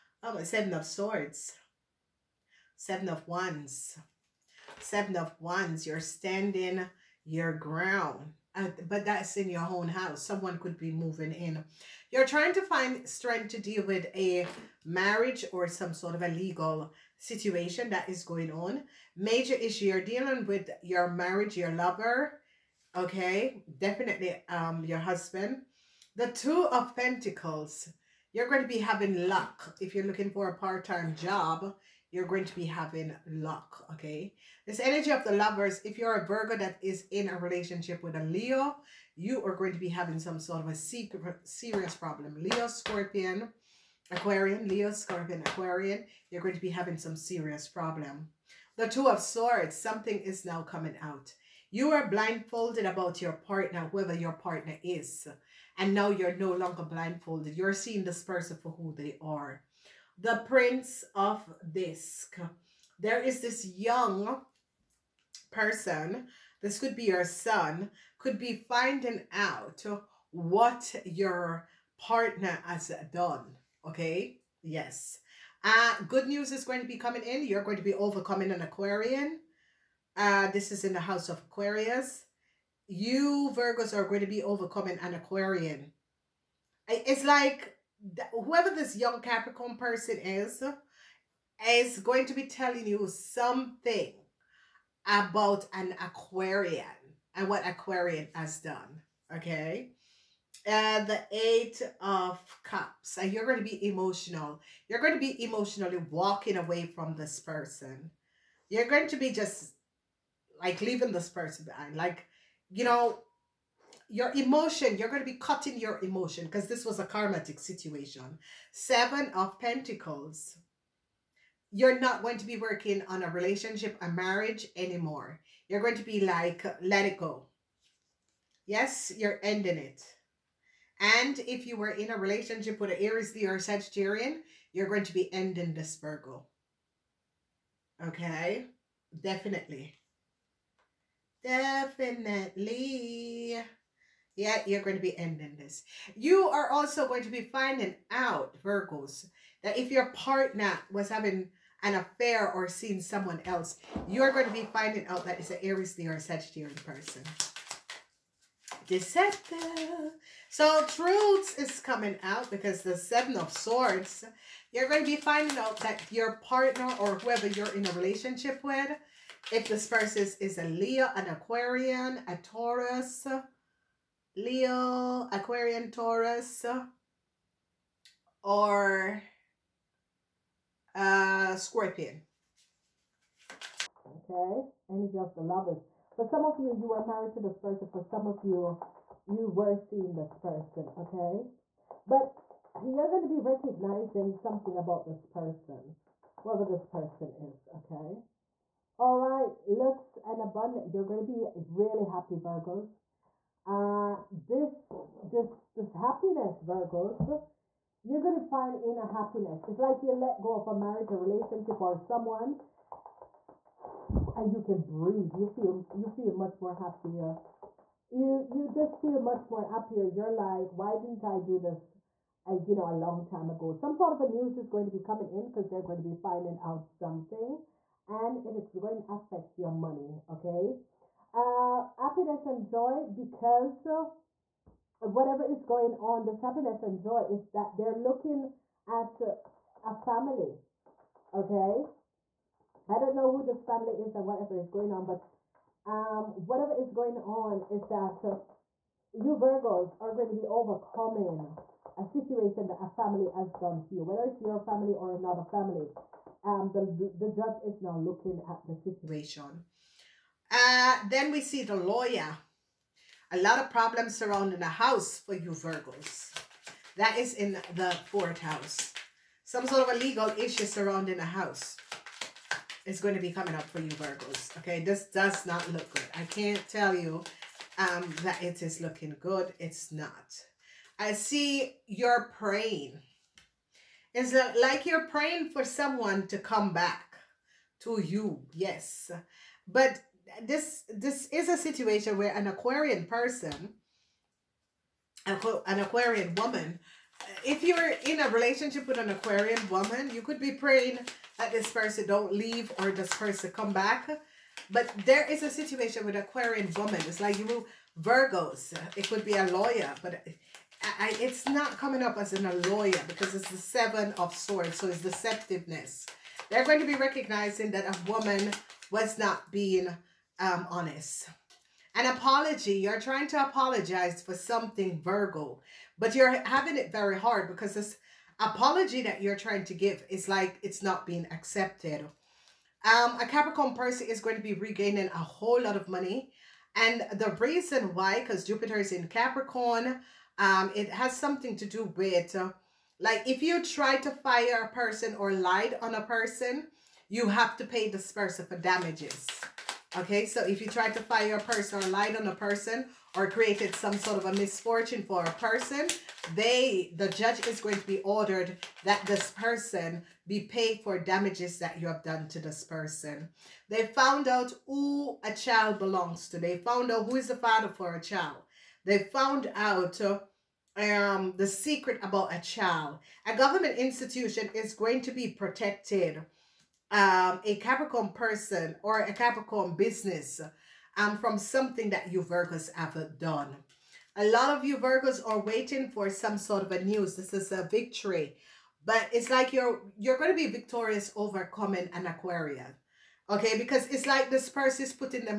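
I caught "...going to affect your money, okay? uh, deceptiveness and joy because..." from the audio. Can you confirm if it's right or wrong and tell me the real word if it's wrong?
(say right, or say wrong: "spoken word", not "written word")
wrong: "happiness", not "deceptiveness".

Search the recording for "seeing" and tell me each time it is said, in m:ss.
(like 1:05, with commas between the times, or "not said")
0:57, 2:32, 3:09.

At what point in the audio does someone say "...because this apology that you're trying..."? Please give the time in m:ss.
5:27.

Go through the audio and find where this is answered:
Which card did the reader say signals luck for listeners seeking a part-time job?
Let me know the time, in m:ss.
0:26.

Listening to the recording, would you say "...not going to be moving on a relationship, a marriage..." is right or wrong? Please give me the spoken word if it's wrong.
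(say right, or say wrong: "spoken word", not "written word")
wrong: "working", not "moving".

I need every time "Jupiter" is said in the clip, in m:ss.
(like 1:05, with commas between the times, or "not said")
5:38.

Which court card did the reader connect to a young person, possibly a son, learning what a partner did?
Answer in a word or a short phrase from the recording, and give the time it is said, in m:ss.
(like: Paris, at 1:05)
Prince of Disc, at 1:00.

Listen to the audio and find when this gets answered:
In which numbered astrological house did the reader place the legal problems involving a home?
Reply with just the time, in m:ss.
4:27.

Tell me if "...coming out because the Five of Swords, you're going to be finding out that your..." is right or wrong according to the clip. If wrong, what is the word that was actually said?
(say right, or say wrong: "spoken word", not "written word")
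wrong: "Seven", not "Five".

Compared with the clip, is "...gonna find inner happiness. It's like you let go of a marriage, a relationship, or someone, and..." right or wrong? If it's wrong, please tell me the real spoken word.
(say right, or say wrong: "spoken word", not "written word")
right.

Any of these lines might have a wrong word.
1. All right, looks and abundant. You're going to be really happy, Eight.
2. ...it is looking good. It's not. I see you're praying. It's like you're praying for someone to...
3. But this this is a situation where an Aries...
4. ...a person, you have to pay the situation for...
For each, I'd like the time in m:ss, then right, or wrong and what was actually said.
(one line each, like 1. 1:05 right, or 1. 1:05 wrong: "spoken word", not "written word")
1. 3:18 wrong: "Virgos", not "Eight"
2. 4:38 right
3. 4:49 wrong: "Aquarian", not "Aries"
4. 5:45 wrong: "person", not "situation".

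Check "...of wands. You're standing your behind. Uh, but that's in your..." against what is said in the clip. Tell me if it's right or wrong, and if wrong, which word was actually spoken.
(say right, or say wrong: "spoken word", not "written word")
wrong: "ground", not "behind".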